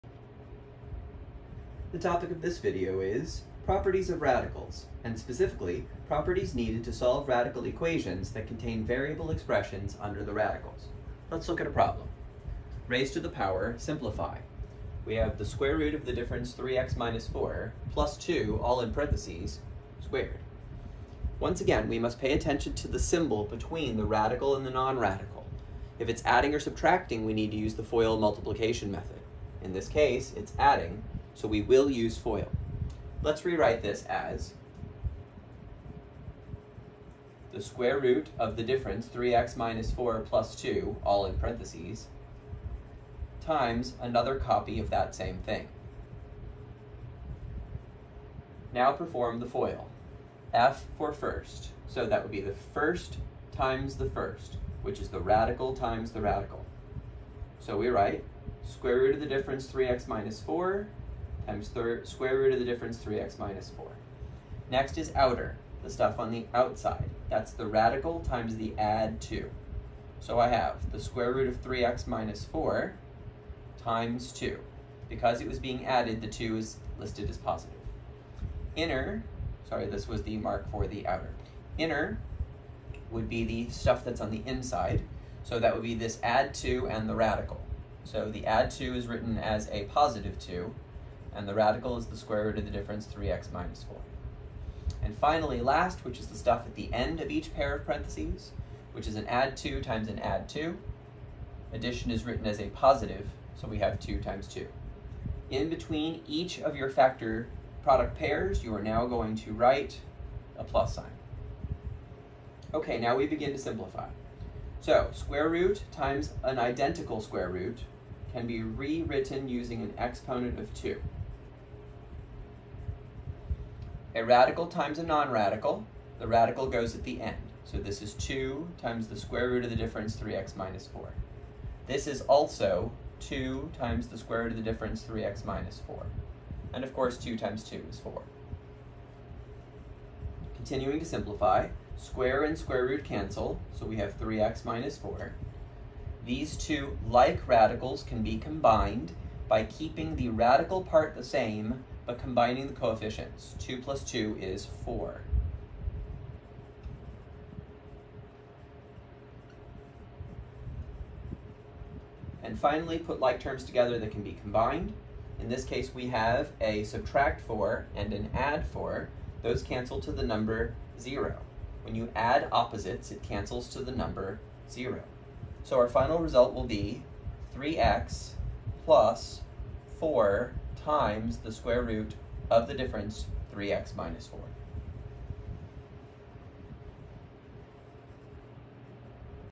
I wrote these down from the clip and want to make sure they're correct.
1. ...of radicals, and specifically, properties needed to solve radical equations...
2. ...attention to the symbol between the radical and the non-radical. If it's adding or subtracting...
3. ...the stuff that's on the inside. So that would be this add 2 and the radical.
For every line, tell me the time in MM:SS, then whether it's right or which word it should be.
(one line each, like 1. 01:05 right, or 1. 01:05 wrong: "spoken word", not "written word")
1. 00:04 right
2. 00:22 right
3. 01:23 right.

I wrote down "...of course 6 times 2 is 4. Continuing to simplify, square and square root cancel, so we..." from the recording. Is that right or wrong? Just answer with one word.
wrong.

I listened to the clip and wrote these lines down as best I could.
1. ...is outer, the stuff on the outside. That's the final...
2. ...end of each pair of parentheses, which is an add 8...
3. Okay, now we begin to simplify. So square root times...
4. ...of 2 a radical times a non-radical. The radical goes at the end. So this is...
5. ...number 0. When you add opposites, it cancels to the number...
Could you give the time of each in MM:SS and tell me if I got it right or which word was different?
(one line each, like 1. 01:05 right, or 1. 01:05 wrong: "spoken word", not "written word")
1. 01:04 wrong: "radical", not "final"
2. 01:36 wrong: "2", not "8"
3. 01:52 right
4. 02:00 right
5. 02:50 right.